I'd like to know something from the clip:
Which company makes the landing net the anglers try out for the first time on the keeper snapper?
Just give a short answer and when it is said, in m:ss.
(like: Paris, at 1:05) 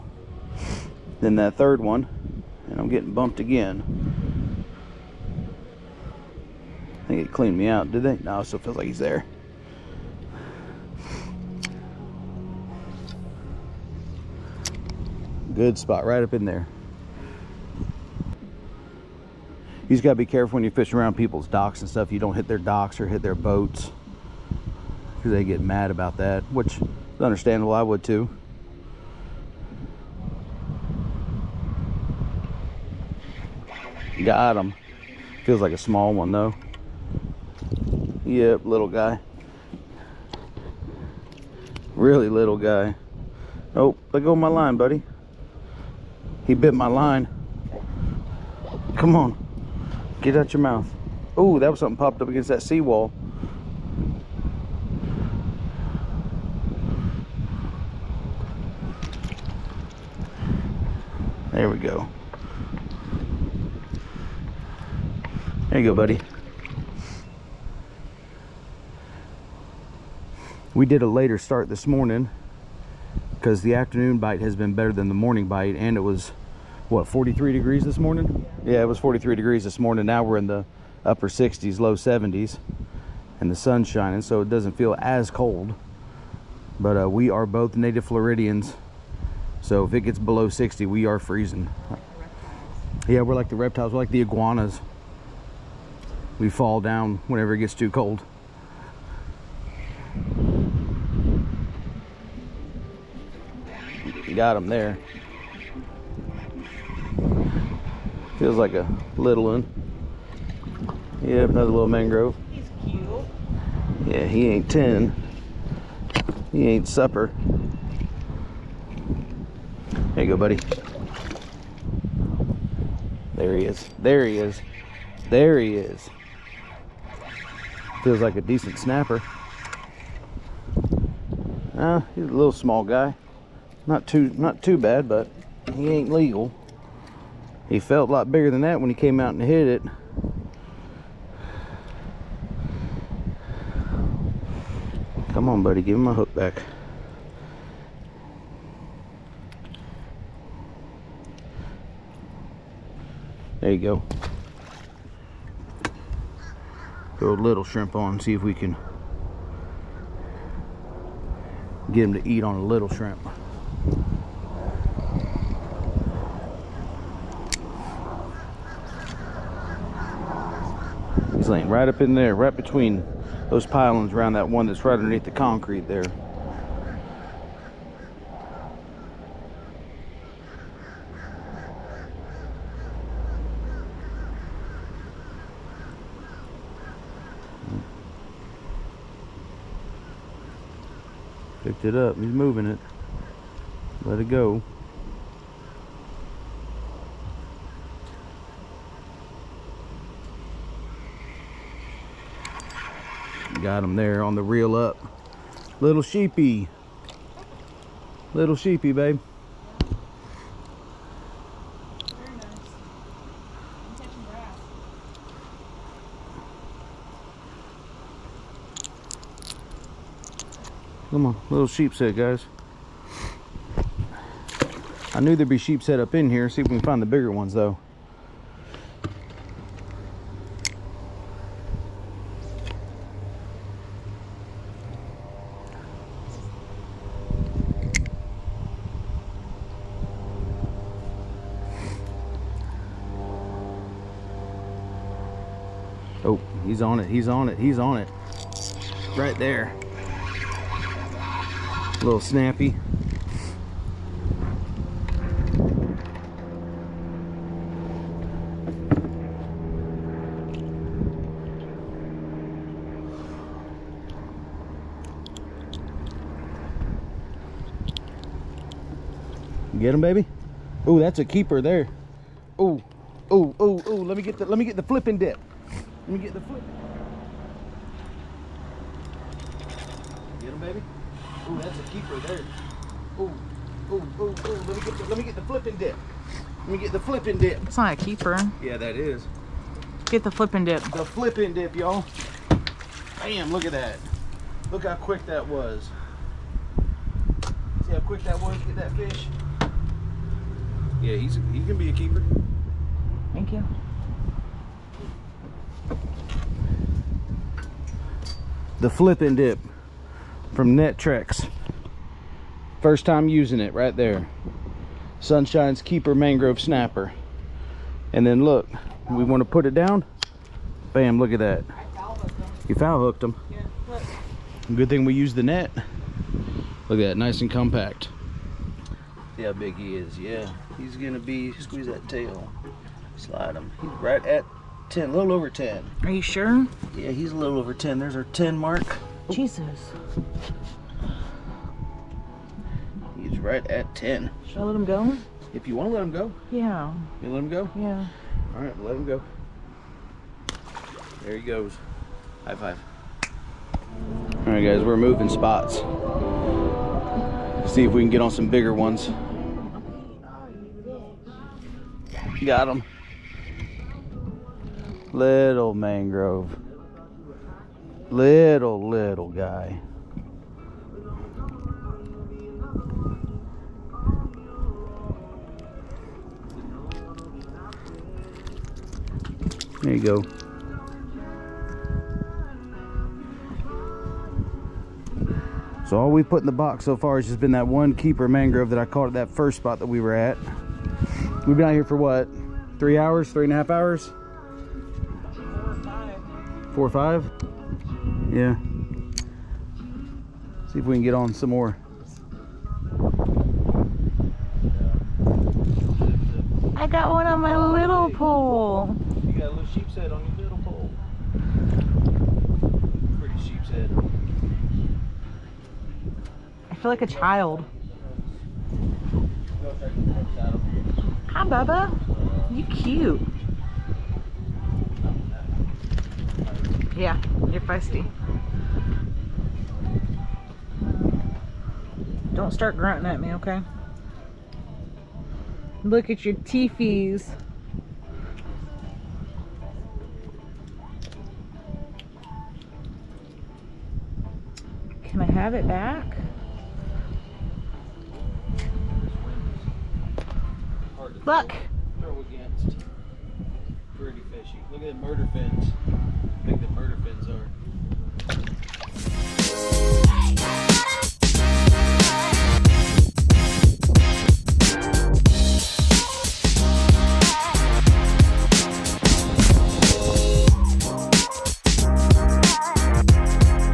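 Nettrex, at 5:10.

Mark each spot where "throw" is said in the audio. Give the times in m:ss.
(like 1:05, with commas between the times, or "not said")
2:37, 7:31.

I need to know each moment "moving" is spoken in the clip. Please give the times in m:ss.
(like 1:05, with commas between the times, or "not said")
3:12, 5:54.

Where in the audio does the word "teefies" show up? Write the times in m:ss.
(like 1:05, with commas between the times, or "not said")
7:16.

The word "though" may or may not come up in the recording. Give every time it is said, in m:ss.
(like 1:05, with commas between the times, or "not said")
0:36, 3:47.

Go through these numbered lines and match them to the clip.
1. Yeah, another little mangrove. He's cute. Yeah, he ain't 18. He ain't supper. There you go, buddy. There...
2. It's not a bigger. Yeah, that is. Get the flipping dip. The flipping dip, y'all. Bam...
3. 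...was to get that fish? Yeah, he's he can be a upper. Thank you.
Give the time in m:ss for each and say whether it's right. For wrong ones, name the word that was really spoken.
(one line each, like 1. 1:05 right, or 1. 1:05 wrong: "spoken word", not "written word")
1. 1:51 wrong: "10", not "18"
2. 4:47 wrong: "keeper", not "bigger"
3. 4:58 wrong: "keeper", not "upper".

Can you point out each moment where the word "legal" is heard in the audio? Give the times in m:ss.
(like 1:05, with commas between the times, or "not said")
2:16.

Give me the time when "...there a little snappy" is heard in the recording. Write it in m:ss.
4:09.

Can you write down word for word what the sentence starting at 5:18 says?
And then look, we want to put it down.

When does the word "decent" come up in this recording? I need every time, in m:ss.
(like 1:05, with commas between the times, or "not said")
2:08.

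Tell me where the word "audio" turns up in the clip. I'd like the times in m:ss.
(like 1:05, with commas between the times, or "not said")
not said.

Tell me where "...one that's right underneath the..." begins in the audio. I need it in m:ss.
2:54.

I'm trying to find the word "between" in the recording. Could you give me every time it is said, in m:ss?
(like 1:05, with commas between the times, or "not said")
2:52.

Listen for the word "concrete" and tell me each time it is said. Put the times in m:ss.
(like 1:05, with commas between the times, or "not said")
2:55.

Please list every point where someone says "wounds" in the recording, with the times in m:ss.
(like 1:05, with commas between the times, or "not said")
not said.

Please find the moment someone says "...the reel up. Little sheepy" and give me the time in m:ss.
3:24.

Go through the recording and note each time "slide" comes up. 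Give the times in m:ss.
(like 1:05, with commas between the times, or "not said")
5:33.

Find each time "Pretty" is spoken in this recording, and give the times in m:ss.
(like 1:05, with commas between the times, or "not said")
6:53, 7:33.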